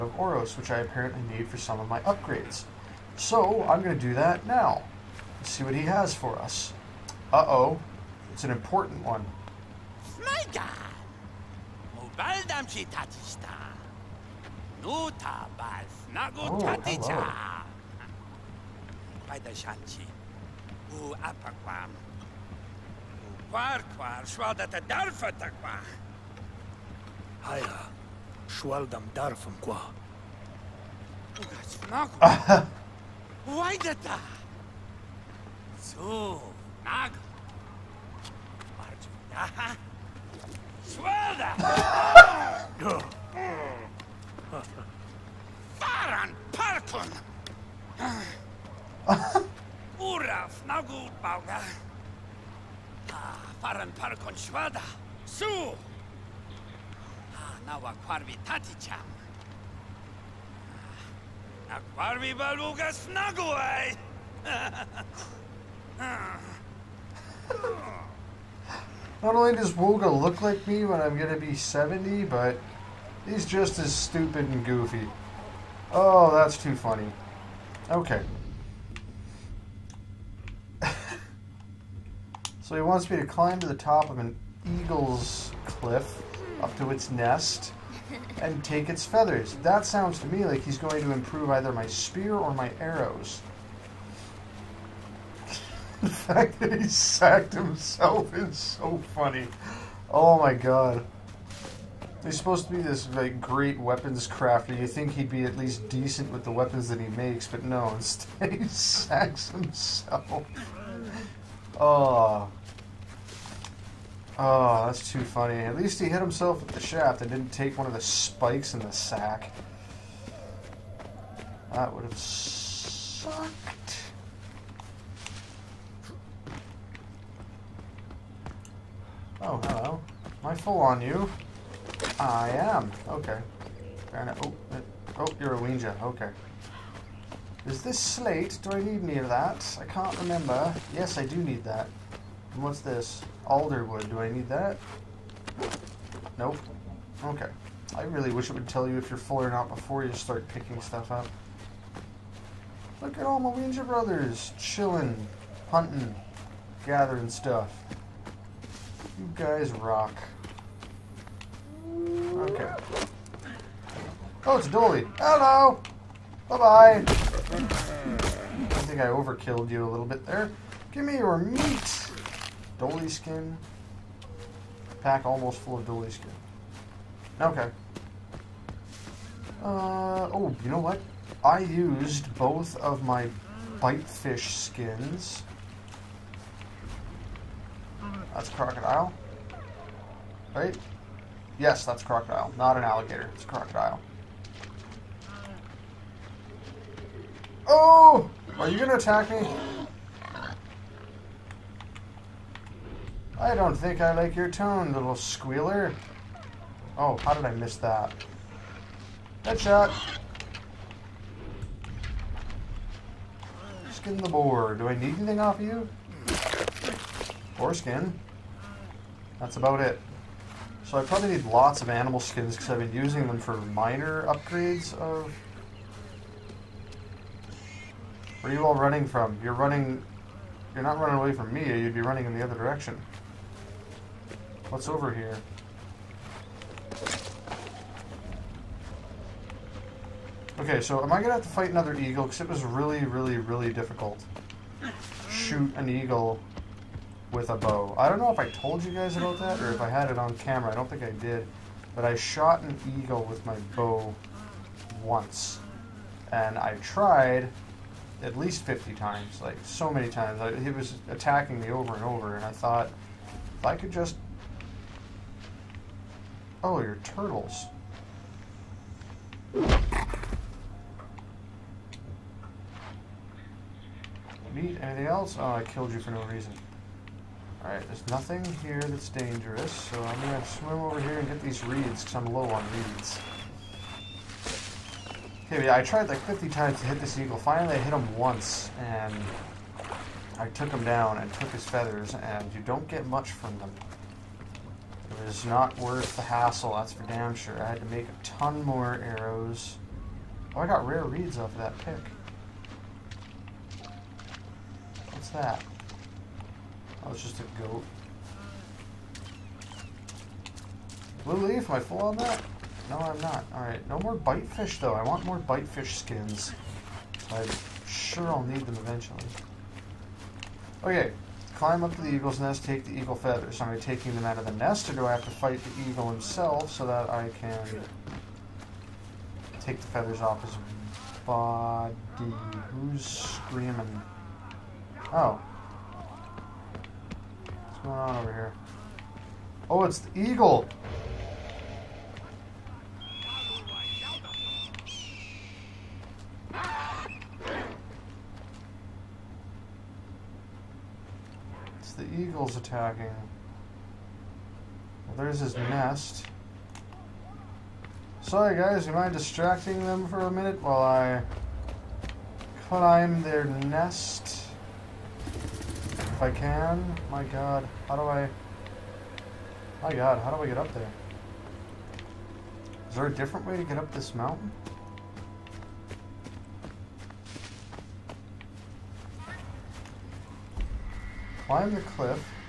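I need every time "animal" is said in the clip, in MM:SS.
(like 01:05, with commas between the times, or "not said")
03:41.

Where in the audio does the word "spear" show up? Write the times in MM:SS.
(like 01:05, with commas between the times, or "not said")
01:31.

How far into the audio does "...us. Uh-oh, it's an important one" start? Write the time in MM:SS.
00:06.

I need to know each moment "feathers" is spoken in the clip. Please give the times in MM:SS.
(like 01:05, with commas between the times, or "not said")
01:29, 04:51, 05:23, 05:29.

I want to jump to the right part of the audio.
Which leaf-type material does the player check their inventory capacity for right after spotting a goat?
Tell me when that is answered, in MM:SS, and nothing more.
05:11.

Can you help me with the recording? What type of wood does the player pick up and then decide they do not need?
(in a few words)
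Alderwood.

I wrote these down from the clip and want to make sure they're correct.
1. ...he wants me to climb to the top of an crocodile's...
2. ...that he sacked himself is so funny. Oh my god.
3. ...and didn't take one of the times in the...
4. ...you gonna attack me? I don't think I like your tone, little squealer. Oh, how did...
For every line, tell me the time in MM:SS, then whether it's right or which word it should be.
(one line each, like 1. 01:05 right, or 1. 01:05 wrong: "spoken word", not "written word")
1. 01:22 wrong: "eagle", not "crocodile"
2. 01:36 right
3. 01:57 wrong: "spikes", not "times"
4. 03:18 right.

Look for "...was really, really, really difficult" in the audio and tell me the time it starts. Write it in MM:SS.
04:02.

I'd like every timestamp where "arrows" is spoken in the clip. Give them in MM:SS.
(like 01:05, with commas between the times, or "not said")
01:32, 04:59.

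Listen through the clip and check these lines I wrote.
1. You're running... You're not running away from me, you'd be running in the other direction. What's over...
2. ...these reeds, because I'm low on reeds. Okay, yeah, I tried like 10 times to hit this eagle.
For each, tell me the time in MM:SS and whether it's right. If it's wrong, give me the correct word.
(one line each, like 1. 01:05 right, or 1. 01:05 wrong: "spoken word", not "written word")
1. 03:49 right
2. 04:41 wrong: "50", not "10".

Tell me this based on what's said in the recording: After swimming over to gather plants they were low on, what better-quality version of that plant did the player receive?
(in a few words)
Rare reeds.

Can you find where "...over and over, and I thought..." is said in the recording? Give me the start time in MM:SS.
04:21.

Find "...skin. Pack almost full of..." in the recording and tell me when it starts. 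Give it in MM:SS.
02:53.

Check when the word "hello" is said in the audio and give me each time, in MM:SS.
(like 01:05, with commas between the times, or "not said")
02:09, 02:45.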